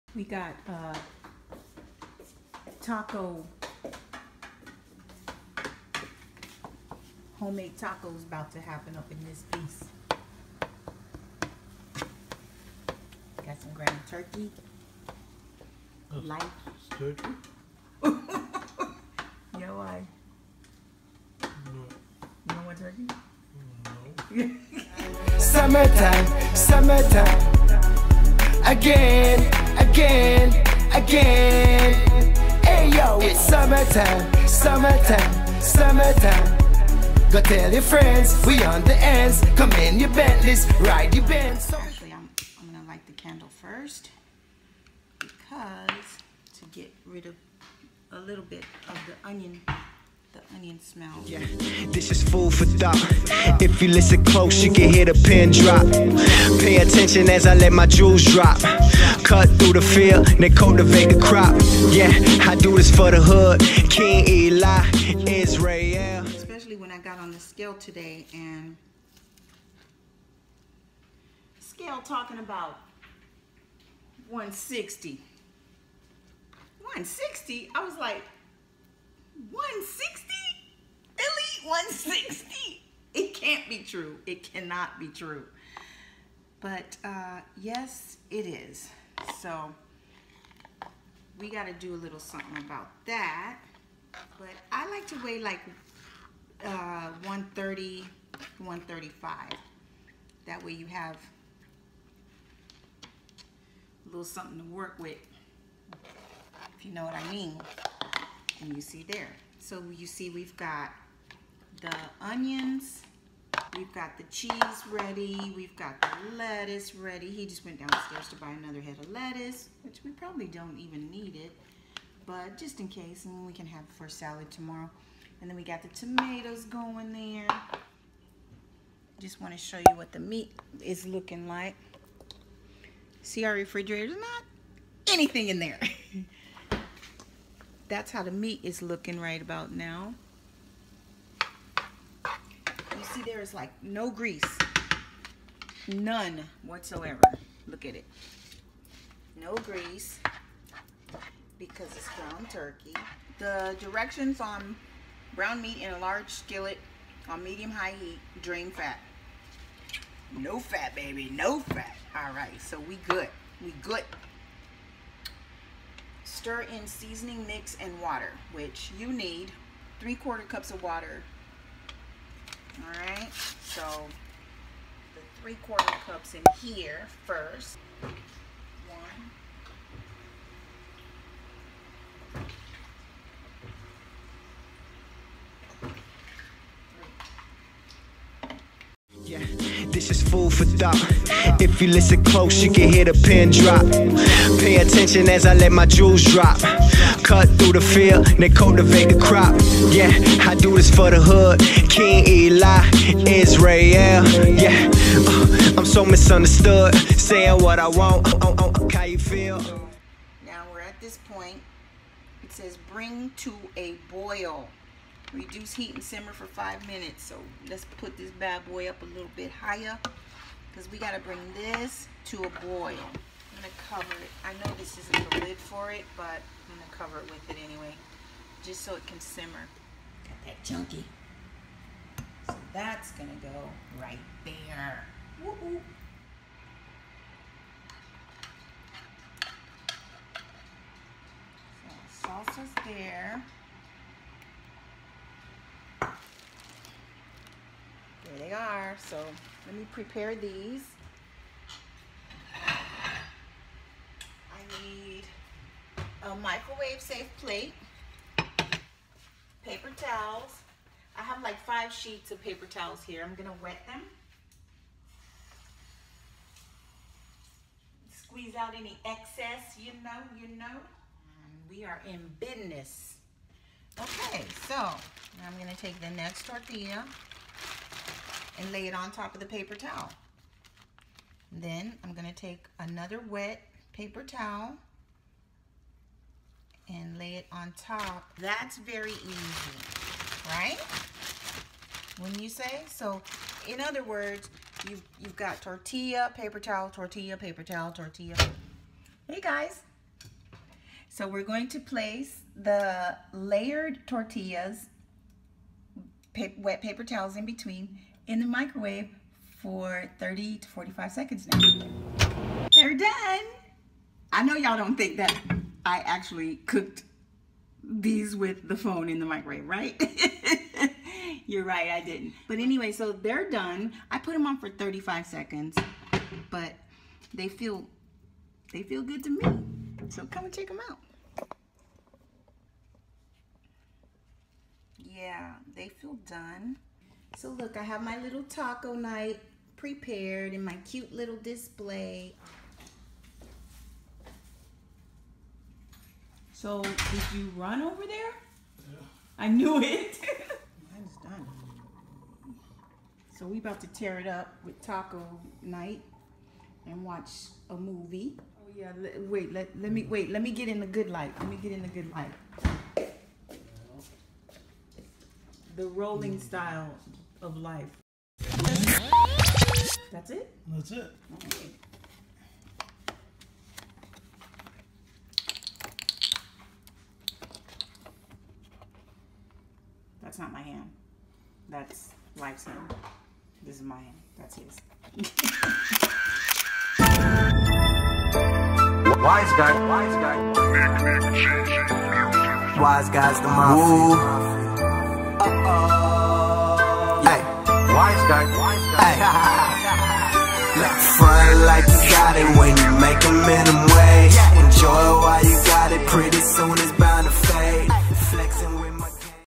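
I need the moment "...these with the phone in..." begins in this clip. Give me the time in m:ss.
5:17.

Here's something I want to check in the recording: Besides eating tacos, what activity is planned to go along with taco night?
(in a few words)
Watch a movie.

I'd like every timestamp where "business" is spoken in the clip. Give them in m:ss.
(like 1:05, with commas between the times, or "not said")
4:32.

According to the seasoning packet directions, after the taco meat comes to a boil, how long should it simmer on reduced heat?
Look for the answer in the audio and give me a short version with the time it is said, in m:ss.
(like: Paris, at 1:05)
5 minutes, at 3:36.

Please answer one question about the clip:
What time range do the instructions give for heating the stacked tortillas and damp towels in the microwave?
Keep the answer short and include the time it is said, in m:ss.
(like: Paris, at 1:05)
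30 to 45 seconds, at 5:10.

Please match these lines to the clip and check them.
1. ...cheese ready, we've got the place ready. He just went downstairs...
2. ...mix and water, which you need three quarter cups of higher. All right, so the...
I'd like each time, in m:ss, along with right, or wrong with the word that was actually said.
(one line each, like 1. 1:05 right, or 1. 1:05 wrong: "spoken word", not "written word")
1. 1:54 wrong: "lettuce", not "place"
2. 2:47 wrong: "water", not "higher".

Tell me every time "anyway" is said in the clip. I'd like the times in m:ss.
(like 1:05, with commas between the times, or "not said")
3:47, 5:22.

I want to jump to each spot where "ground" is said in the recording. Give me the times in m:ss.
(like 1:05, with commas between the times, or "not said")
0:13, 2:32.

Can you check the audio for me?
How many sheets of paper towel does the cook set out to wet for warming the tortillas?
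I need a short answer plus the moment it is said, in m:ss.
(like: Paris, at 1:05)
5 sheets, at 4:21.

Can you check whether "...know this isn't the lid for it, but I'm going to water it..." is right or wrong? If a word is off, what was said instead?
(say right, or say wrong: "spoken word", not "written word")
wrong: "cover", not "water".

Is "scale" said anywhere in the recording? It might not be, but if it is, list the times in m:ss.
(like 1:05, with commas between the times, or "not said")
1:07, 1:11.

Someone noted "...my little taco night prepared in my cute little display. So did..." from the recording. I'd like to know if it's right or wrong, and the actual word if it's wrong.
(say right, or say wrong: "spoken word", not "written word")
right.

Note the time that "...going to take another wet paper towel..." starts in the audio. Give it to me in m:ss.
4:42.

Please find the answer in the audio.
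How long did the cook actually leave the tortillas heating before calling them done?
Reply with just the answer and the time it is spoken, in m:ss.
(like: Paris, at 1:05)
35 seconds, at 5:24.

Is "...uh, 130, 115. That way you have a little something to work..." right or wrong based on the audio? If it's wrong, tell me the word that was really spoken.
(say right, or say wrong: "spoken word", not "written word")
wrong: "135", not "115".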